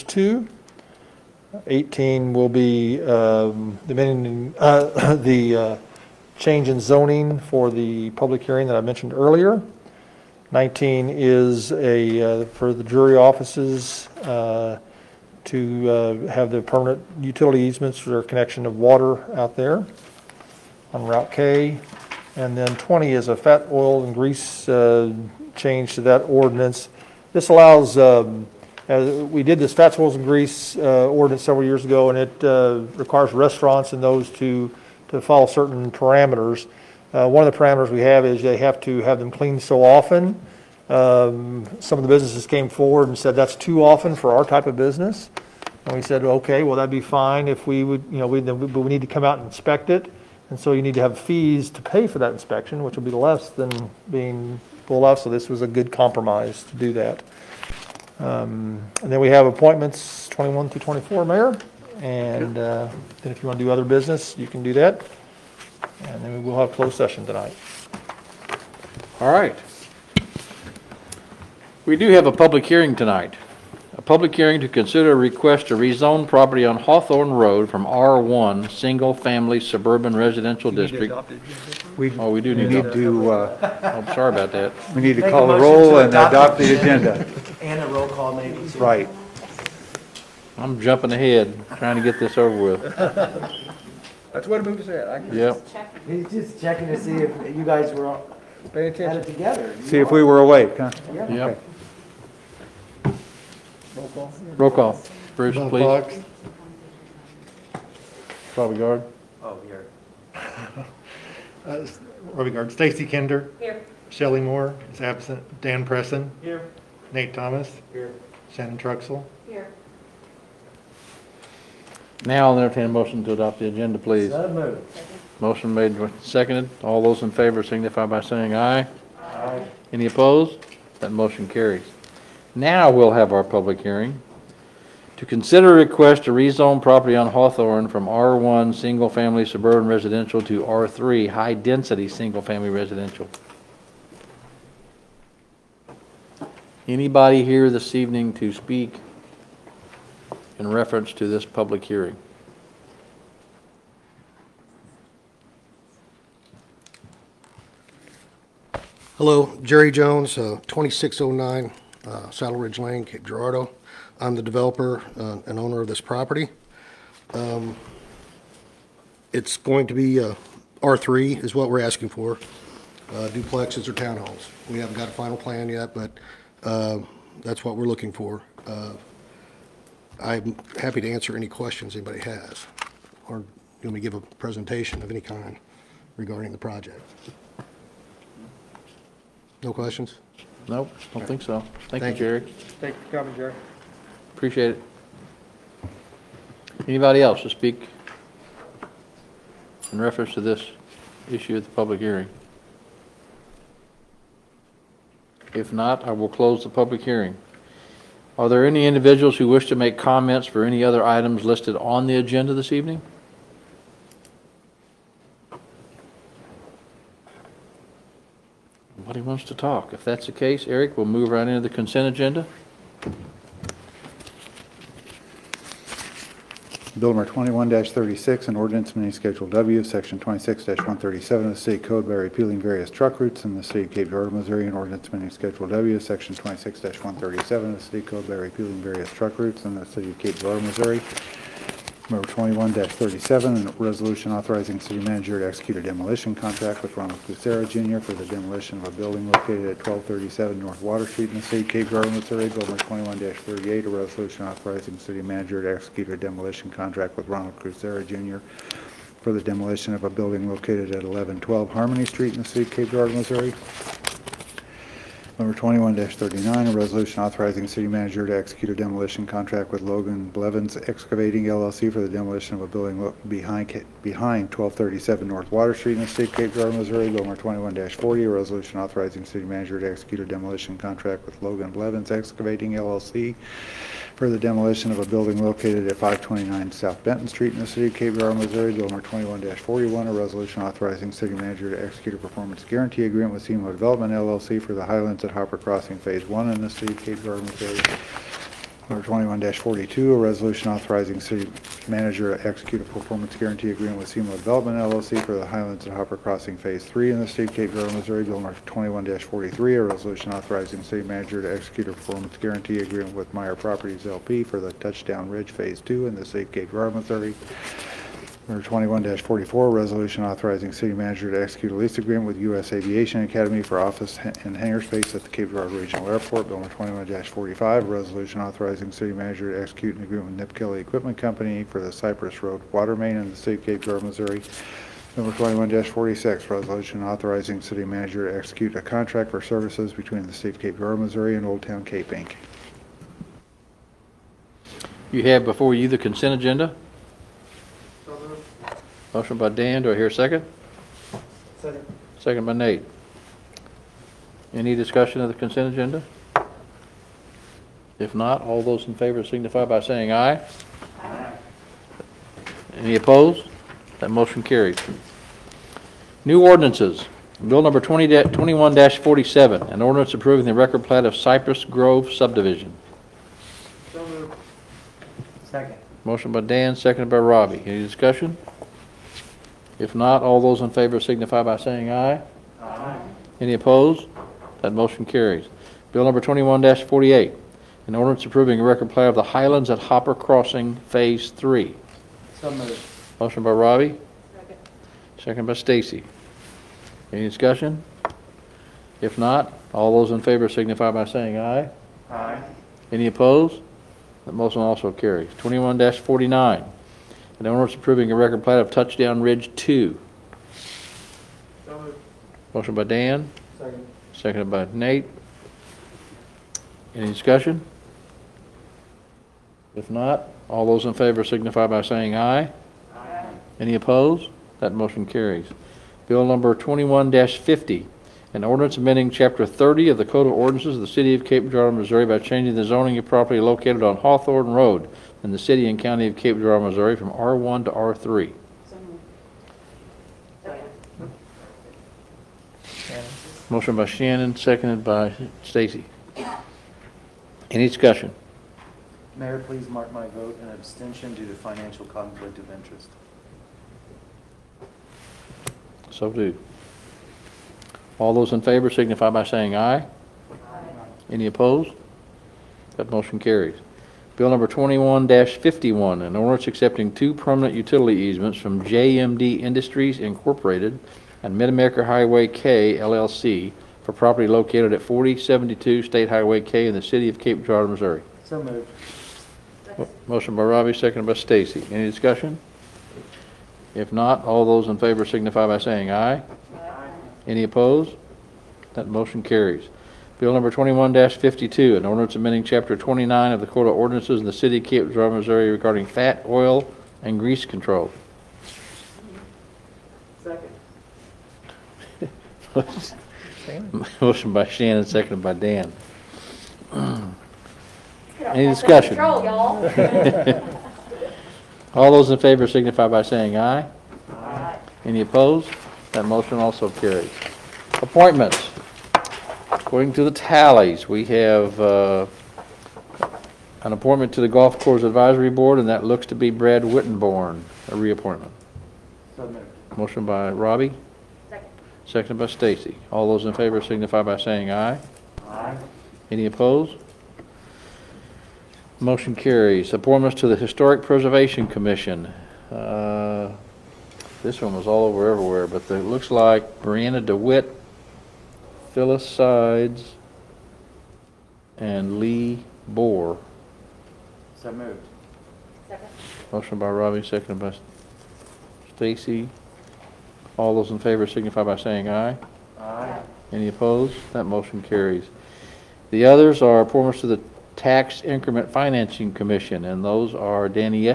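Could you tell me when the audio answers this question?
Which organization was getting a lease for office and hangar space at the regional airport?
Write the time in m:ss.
5:22.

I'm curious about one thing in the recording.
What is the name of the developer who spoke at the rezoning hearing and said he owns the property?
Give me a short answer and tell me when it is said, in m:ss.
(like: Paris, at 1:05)
Jerry Jones, at 2:39.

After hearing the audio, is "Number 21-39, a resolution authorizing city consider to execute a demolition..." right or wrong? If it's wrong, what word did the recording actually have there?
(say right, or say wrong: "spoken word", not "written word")
wrong: "manager", not "consider".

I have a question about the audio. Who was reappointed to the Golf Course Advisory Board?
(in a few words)
Brad Wittenborn.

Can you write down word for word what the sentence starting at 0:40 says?
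Um, some of the businesses came forward and said that's too often for our type of business.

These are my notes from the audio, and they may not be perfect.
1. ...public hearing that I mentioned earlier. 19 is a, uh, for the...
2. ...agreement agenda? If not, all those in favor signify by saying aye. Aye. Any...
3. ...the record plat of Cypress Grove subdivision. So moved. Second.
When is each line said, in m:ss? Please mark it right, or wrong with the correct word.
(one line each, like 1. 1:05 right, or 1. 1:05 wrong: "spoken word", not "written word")
1. 0:08 right
2. 5:55 wrong: "consent", not "agreement"
3. 6:10 right.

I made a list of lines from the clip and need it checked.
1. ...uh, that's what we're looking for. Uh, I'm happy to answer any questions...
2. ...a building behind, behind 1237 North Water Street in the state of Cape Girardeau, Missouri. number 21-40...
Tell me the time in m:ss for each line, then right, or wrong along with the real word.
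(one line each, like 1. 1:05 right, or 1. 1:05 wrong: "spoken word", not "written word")
1. 2:56 right
2. 4:32 right.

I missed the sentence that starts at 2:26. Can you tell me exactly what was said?
Anybody here this evening to speak in reference to this public hearing.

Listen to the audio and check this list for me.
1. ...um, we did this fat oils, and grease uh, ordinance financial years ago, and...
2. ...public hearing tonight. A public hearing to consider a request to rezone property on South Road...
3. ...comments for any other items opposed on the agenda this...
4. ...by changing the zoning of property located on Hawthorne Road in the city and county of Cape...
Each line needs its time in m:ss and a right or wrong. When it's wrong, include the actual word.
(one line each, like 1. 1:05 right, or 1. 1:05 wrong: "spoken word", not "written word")
1. 0:27 wrong: "several", not "financial"
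2. 1:12 wrong: "Hawthorne", not "South"
3. 3:29 wrong: "listed", not "opposed"
4. 7:12 right.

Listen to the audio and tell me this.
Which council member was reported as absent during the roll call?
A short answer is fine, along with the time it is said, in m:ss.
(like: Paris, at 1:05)
Shelley Moore, at 1:54.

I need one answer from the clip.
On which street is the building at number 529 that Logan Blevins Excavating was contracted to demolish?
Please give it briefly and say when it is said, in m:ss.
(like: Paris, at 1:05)
South Benton Street, at 4:46.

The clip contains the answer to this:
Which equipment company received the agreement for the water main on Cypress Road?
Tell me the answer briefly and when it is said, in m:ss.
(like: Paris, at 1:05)
Nip Kelly Equipment Company, at 5:30.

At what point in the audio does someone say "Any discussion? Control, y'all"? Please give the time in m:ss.
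8:28.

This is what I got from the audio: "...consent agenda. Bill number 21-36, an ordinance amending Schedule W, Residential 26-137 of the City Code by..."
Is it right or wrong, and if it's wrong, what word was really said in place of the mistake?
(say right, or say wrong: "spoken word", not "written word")
wrong: "Section", not "Residential".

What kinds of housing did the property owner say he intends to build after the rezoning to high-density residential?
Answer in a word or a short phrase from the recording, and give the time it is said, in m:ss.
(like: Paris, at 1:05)
duplexes or townhomes, at 2:53.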